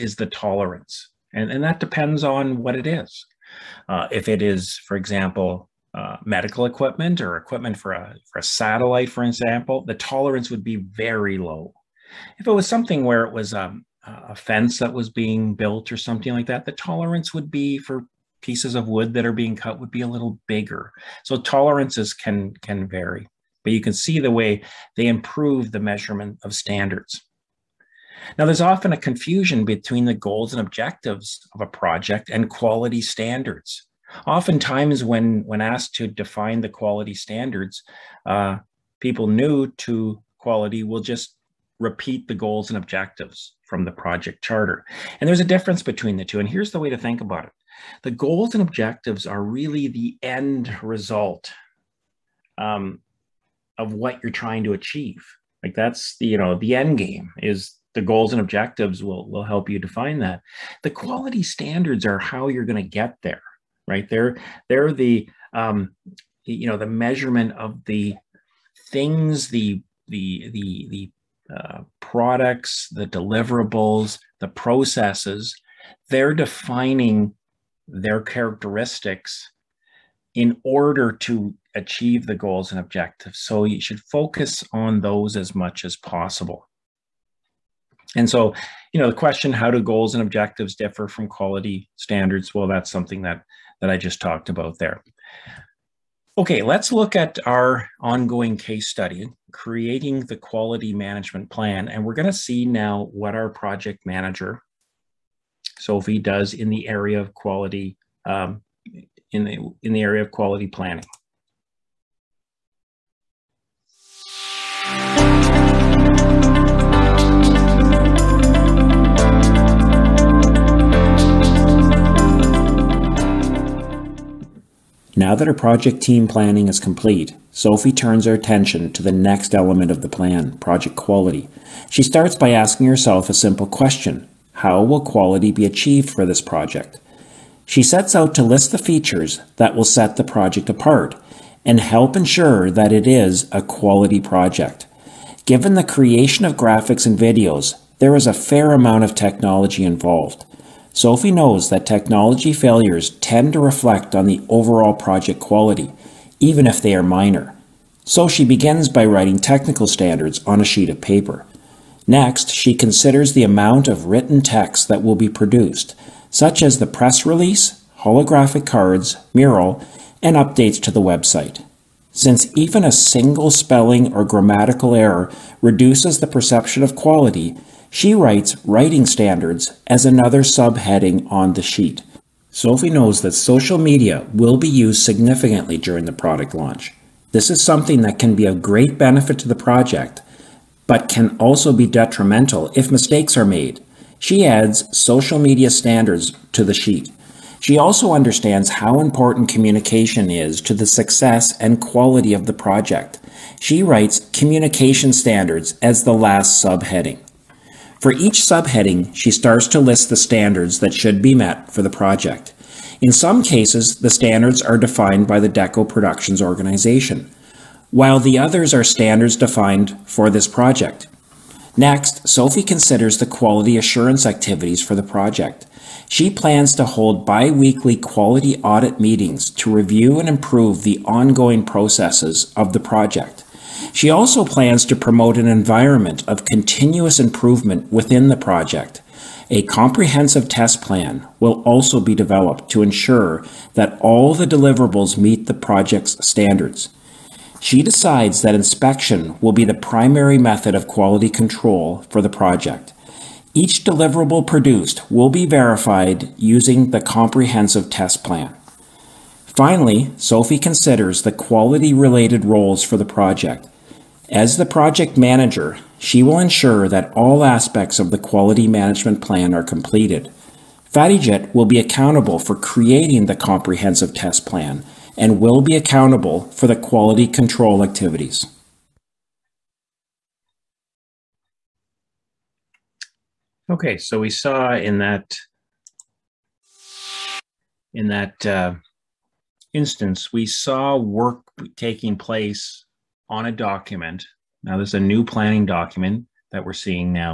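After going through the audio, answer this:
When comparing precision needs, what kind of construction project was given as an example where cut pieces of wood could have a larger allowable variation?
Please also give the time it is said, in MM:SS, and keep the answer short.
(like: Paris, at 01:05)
A fence, at 00:14.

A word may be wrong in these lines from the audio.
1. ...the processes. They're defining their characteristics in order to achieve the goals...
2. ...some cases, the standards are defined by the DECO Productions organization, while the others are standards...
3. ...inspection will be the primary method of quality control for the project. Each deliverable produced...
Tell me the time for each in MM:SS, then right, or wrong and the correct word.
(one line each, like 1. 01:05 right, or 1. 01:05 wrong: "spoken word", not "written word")
1. 01:14 right
2. 03:33 right
3. 04:08 right.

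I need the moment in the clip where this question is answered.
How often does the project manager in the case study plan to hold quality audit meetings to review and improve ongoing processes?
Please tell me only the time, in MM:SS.
03:47.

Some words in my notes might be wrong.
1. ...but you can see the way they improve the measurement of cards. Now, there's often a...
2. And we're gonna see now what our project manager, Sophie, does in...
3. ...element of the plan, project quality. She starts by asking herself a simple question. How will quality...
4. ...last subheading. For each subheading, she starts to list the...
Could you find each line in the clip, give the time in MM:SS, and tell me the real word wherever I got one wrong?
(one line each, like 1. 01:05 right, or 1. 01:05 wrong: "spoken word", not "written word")
1. 00:23 wrong: "standards", not "cards"
2. 01:41 right
3. 02:09 right
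4. 03:26 right.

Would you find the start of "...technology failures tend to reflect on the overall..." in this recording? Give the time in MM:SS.
02:31.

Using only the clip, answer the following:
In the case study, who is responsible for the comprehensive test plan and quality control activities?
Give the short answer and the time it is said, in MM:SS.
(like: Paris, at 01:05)
FattyJet, at 04:30.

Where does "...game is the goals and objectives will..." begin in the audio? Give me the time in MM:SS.
00:56.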